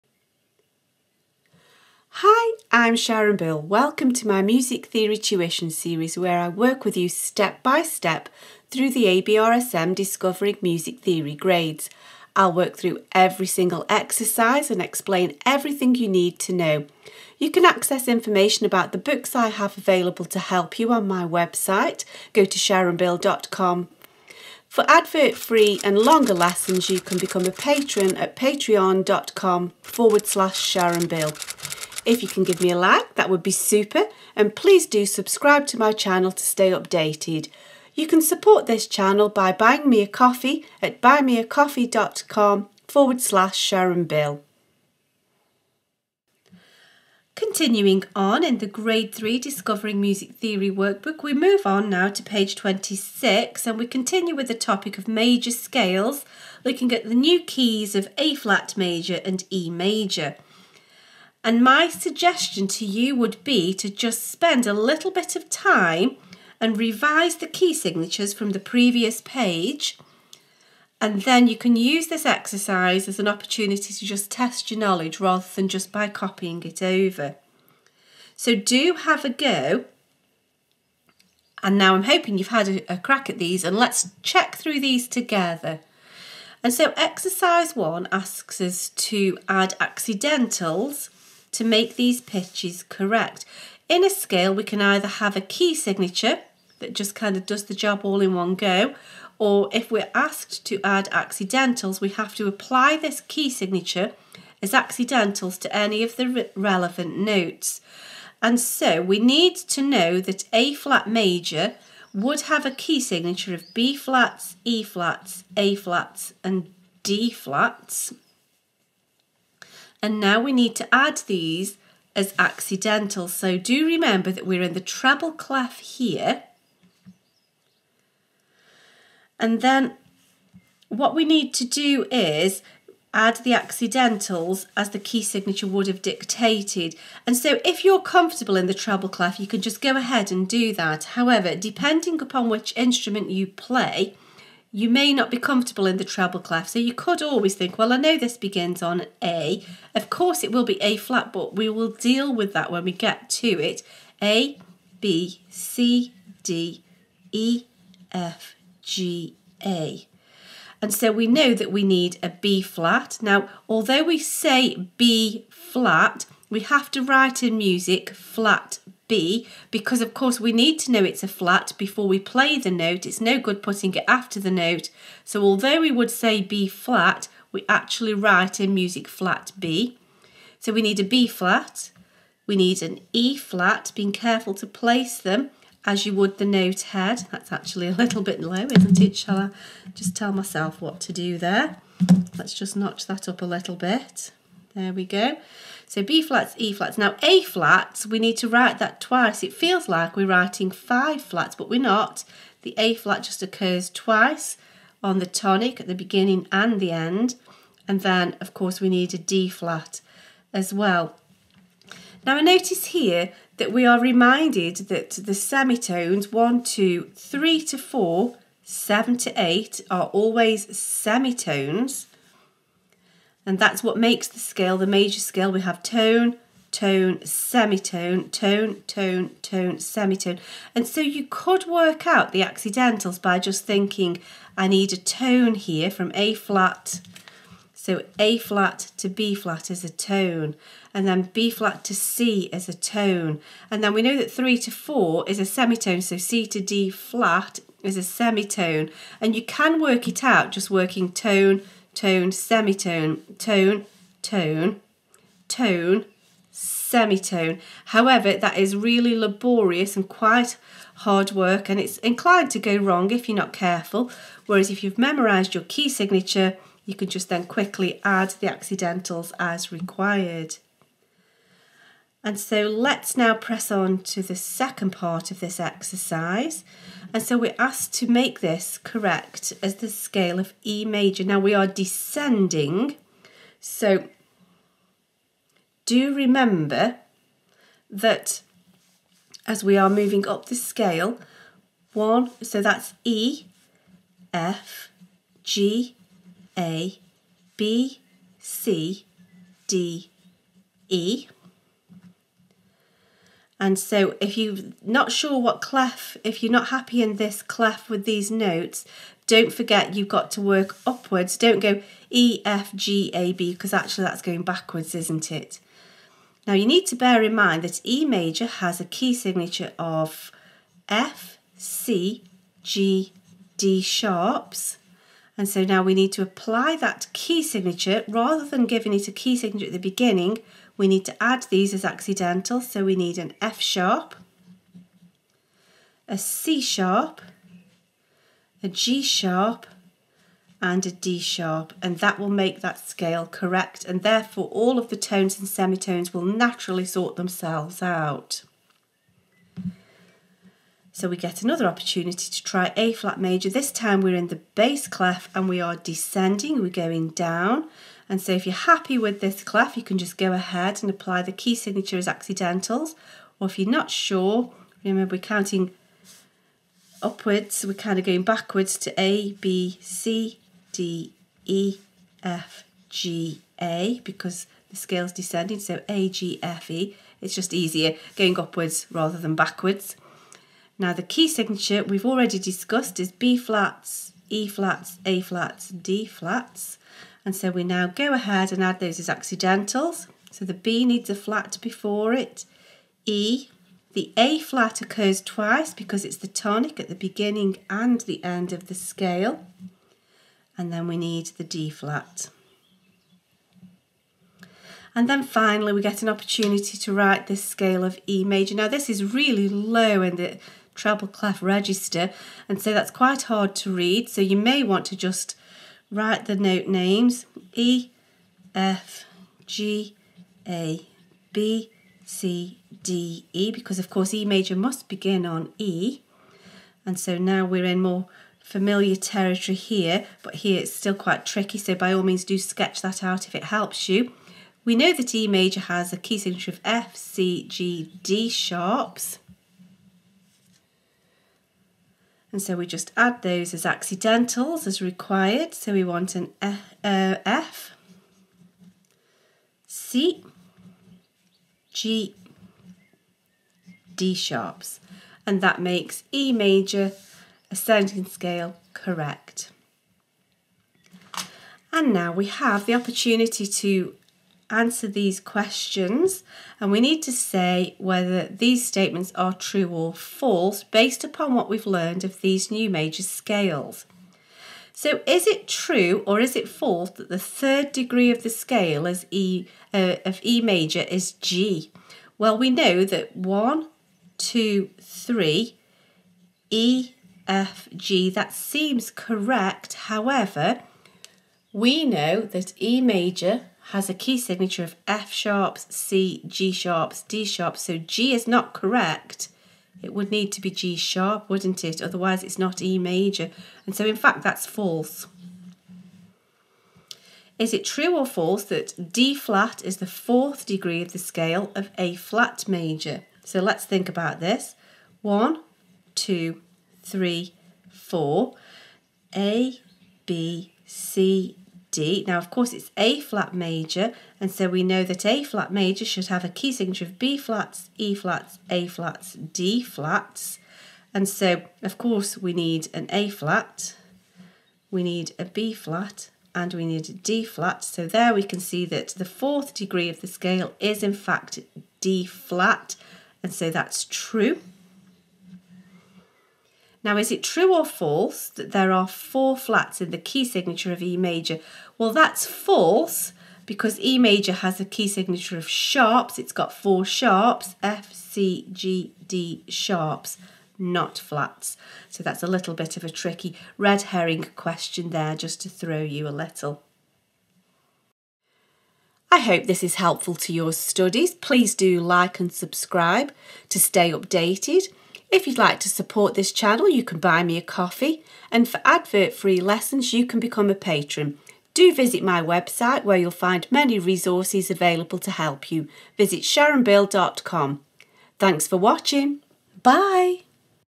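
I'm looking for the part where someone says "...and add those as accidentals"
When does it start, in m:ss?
6:28.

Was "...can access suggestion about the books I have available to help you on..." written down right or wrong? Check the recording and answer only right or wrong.
wrong.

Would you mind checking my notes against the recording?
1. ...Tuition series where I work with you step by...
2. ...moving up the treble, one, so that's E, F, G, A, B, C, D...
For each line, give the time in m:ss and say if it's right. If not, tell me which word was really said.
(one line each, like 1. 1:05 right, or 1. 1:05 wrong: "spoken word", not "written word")
1. 0:05 right
2. 4:49 wrong: "scale", not "treble".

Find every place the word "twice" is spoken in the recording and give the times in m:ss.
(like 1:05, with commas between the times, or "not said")
3:19, 3:23, 6:35.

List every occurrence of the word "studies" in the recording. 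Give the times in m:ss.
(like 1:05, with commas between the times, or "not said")
9:30.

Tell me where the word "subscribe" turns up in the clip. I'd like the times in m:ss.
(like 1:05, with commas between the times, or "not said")
0:35, 9:32.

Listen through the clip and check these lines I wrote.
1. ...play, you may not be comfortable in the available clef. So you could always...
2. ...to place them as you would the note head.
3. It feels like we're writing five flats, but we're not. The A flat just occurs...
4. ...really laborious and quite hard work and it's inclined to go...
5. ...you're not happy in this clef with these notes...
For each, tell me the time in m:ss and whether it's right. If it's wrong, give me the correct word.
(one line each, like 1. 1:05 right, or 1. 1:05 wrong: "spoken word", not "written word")
1. 2:23 wrong: "treble", not "available"
2. 3:04 right
3. 3:19 right
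4. 4:18 right
5. 5:06 right.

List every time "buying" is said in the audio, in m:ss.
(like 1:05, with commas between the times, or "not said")
0:39.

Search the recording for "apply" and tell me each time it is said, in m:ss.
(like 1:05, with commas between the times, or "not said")
1:42, 5:26, 6:00.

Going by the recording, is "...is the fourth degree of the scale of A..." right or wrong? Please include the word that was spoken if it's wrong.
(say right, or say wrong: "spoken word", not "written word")
right.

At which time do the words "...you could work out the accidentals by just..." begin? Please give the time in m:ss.
3:51.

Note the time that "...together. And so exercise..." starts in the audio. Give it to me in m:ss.
1:25.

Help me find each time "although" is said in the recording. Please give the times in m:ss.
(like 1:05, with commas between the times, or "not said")
2:43, 2:55.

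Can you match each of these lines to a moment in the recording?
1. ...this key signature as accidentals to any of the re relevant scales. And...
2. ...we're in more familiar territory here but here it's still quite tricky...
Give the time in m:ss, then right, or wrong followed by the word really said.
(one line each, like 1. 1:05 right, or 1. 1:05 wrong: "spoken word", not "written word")
1. 1:42 wrong: "notes", not "scales"
2. 7:07 right.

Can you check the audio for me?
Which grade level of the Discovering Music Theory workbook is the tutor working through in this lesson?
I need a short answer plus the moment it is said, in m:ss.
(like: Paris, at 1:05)
Grade 3, at 0:48.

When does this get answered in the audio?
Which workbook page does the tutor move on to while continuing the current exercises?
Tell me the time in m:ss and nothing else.
0:52.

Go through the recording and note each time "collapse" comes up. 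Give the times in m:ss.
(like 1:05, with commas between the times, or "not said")
not said.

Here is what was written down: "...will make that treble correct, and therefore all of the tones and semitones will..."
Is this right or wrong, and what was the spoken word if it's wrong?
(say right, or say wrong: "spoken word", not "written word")
wrong: "scale", not "treble".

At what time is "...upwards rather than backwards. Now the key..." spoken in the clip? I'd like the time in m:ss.
6:18.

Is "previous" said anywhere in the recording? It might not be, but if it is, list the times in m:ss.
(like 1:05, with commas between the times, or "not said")
1:08.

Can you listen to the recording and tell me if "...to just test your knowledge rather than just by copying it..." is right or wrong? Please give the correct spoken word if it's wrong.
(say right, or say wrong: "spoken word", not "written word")
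right.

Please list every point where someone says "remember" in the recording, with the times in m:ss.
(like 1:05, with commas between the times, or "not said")
2:03, 4:46, 6:04.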